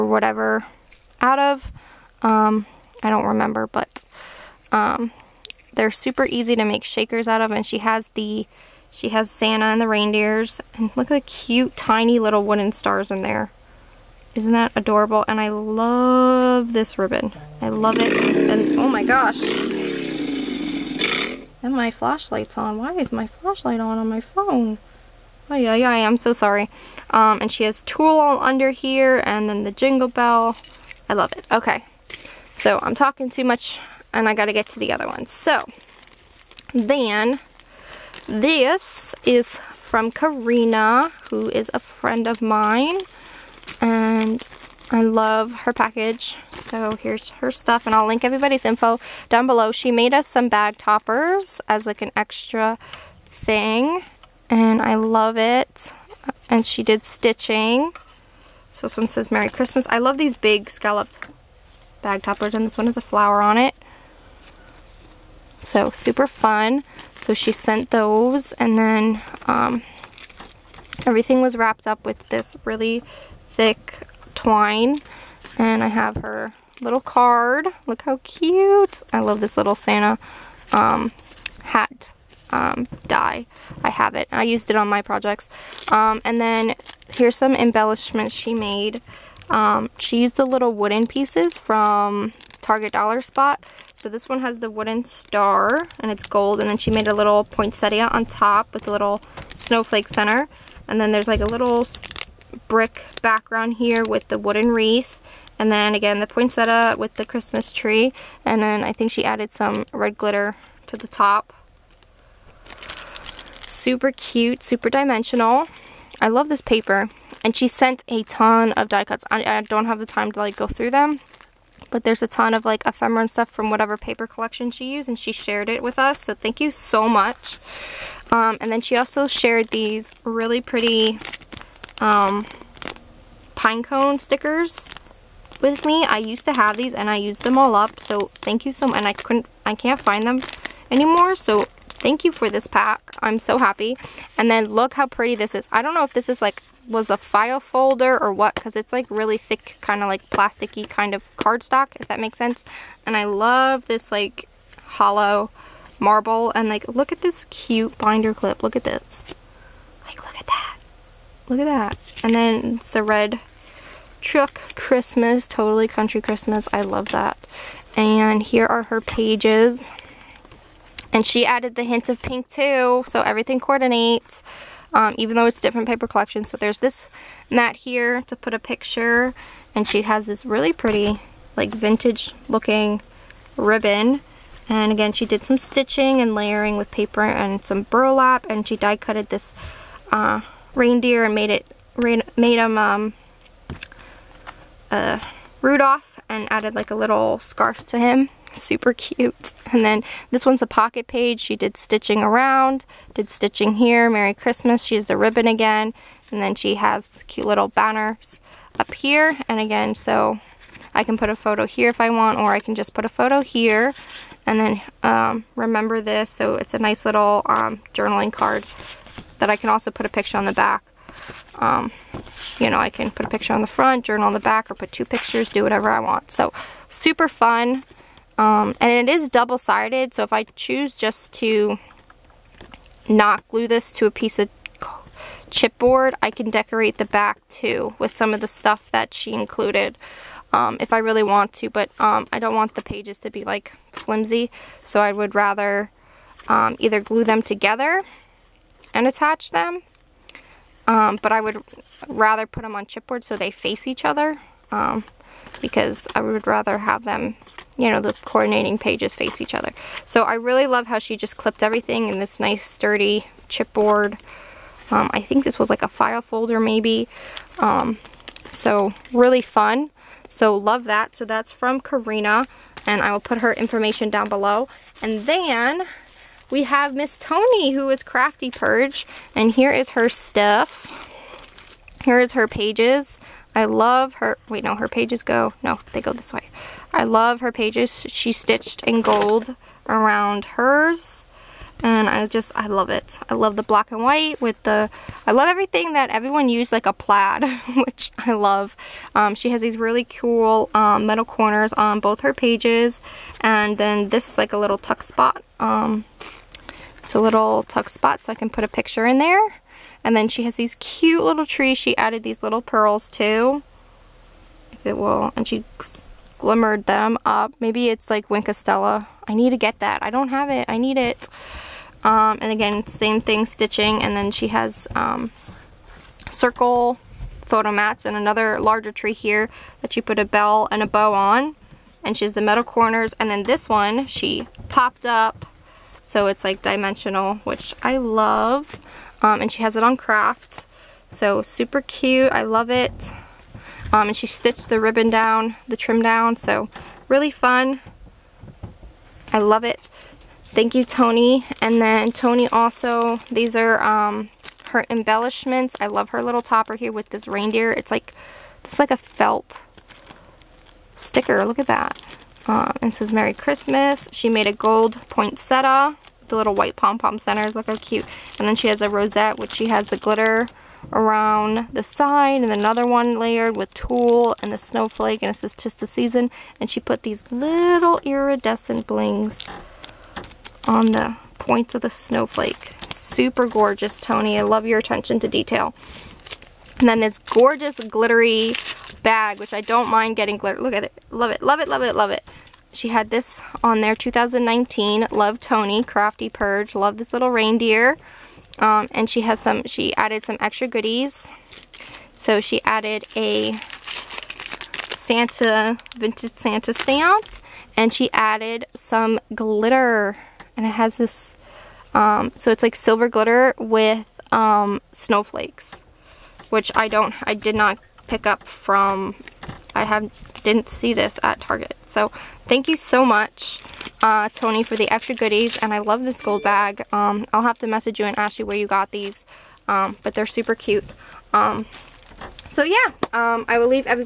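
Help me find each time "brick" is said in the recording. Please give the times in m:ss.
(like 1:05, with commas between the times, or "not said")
1:42.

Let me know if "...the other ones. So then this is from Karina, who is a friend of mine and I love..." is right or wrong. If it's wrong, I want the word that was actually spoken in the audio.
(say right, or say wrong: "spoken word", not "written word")
right.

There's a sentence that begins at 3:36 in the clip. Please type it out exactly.
So it's a nice little um, journaling card that I can also put a picture on the back.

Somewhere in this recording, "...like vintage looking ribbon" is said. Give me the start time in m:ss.
3:01.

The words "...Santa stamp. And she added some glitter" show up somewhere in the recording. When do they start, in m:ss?
6:46.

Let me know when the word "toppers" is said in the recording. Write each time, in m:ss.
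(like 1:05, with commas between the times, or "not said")
0:50, 1:02, 5:56.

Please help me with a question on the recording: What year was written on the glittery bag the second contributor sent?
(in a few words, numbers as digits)
2019.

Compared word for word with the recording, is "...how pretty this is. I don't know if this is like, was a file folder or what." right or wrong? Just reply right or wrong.
right.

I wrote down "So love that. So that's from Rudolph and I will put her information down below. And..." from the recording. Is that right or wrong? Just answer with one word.
wrong.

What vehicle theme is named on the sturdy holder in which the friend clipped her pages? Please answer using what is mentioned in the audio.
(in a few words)
Red truck.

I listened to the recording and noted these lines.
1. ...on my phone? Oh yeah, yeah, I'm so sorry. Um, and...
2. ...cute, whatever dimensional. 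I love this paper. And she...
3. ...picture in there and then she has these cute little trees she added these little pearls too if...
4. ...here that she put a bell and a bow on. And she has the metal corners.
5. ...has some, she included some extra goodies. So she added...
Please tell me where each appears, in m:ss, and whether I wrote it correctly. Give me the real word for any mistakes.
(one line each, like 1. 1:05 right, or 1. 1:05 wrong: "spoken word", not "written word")
1. 0:23 right
2. 1:54 wrong: "super", not "whatever"
3. 5:08 right
4. 5:29 right
5. 6:39 wrong: "added", not "included".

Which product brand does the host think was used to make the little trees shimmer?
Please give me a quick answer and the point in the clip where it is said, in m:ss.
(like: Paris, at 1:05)
Stella, at 5:18.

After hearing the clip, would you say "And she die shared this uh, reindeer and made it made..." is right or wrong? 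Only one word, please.
wrong.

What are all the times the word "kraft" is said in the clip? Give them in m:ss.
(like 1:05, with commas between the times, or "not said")
5:39.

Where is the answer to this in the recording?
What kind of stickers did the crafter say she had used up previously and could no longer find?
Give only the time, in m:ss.
2:13.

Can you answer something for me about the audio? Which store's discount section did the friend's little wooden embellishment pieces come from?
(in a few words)
Target Dollar Spot.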